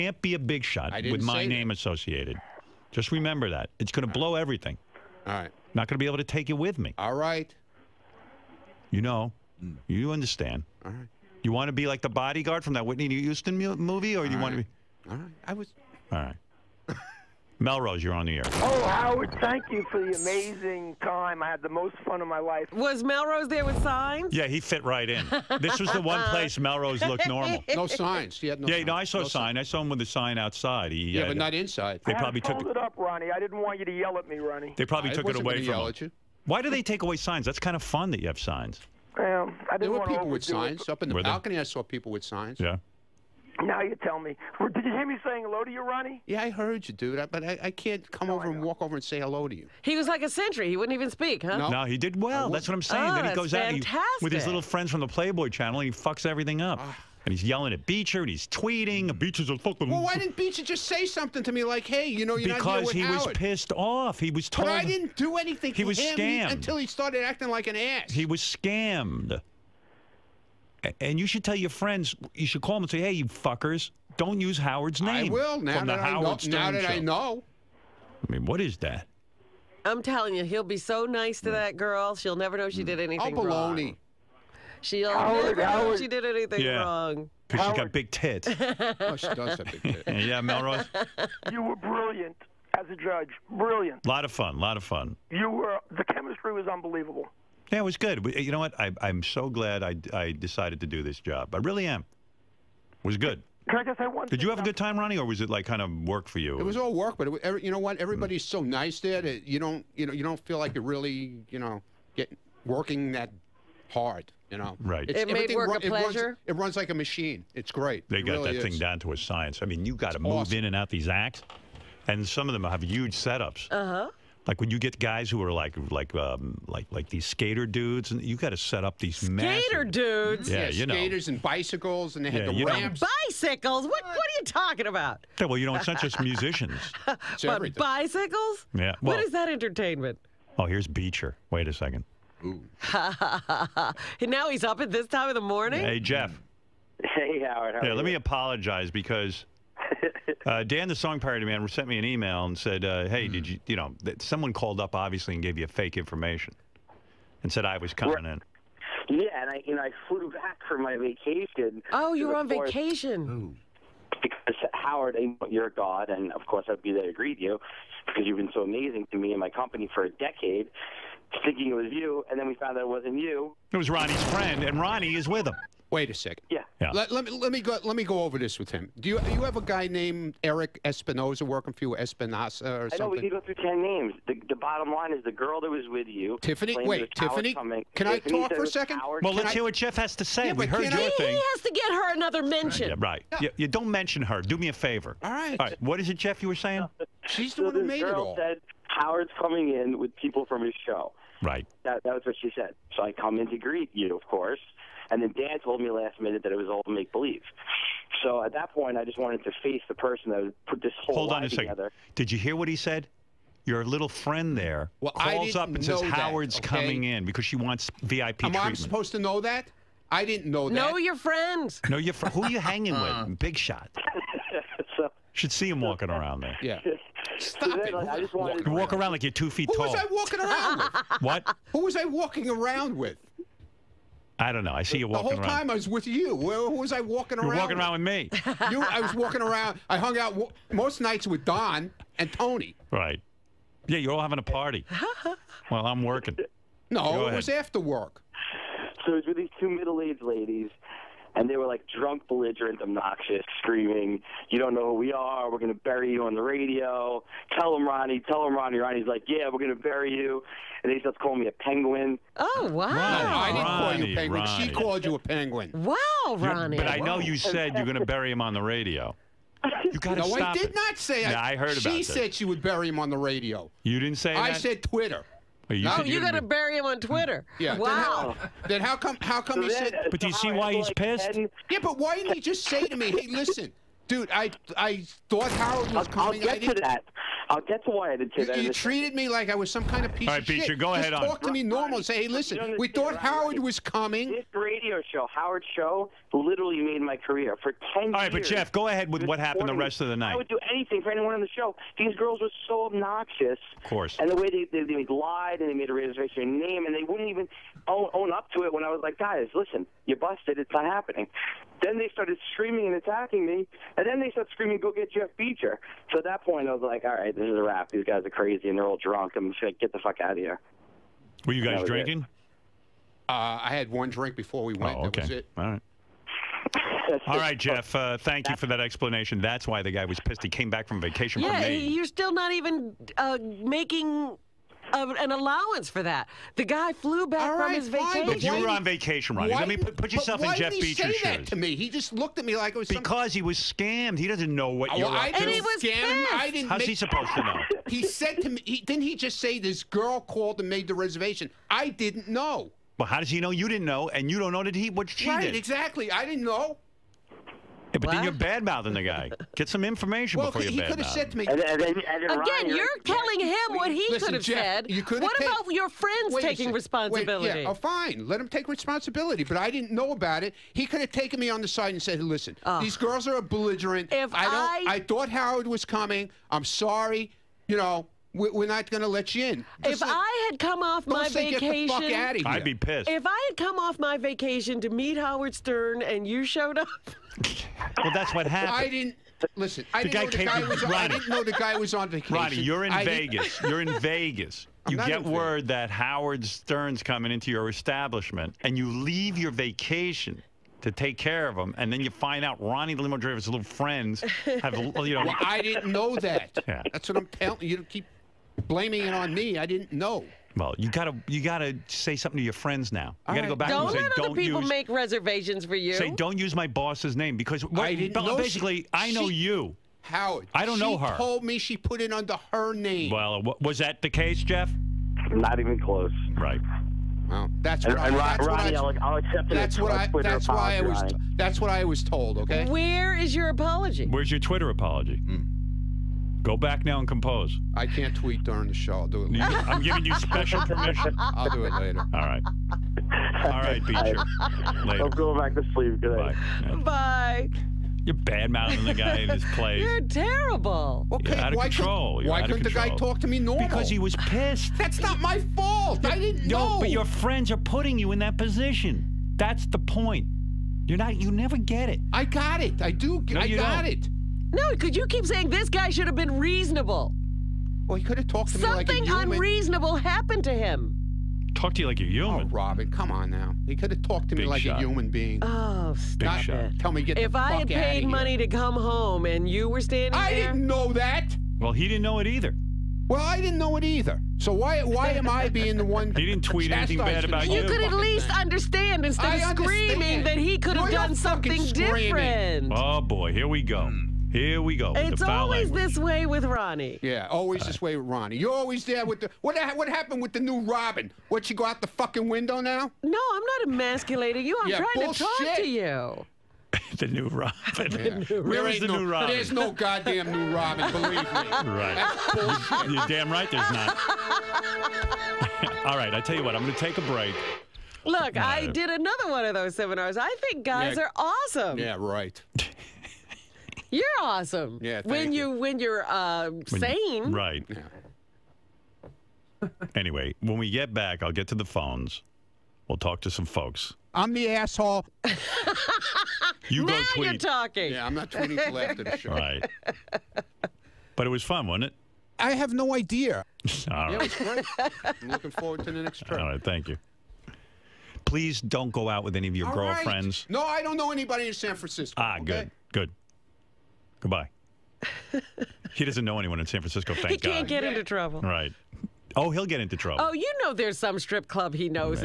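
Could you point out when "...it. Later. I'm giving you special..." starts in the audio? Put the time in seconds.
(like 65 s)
439 s.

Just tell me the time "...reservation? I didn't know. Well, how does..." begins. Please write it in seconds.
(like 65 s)
350 s.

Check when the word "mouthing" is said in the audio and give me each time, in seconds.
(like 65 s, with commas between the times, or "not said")
358 s, 448 s.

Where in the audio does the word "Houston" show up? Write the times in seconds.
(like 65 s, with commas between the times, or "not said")
13 s.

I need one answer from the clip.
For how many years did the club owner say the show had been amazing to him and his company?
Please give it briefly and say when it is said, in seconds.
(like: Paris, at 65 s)
a decade, at 170 s.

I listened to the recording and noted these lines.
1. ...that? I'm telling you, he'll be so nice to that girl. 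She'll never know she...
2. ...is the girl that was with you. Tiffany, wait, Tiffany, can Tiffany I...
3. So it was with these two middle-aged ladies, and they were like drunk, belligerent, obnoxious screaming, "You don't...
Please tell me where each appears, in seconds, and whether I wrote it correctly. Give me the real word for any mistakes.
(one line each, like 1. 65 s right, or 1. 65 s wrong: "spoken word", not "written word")
1. 78 s right
2. 185 s right
3. 249 s right.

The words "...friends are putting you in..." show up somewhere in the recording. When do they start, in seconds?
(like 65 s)
457 s.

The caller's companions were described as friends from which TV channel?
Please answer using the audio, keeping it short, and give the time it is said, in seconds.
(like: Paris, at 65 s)
Playboy Channel, at 55 s.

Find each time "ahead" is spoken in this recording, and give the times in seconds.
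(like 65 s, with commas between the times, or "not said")
290 s, 298 s.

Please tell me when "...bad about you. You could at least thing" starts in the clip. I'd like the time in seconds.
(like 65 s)
486 s.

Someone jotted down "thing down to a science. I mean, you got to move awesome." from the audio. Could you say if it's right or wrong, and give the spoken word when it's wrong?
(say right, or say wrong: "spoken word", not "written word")
right.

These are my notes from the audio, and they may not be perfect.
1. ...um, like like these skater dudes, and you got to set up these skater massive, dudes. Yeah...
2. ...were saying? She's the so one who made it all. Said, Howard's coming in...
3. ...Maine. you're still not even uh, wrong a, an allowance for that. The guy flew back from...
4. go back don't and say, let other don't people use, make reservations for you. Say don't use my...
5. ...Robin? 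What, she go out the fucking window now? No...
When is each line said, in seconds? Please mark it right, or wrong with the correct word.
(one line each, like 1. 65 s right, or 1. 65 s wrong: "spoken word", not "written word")
1. 126 s right
2. 196 s right
3. 331 s wrong: "making", not "wrong"
4. 413 s right
5. 500 s right.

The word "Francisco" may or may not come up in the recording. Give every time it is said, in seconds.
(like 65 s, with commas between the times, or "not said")
551 s, 556 s.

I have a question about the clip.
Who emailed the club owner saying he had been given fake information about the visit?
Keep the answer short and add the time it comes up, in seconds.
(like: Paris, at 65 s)
Dan, the song parody man, at 150 s.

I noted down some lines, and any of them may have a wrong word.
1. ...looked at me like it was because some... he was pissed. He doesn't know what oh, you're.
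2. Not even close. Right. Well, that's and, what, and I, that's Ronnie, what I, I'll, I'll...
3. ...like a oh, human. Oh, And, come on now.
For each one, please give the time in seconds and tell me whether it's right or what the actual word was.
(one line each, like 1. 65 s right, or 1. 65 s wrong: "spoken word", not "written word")
1. 342 s wrong: "scammed", not "pissed"
2. 425 s right
3. 471 s wrong: "Robin", not "And".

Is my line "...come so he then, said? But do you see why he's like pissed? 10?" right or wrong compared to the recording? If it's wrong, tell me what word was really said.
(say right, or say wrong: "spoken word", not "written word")
right.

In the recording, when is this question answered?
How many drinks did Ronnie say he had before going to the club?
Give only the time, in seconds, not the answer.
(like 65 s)
323 s.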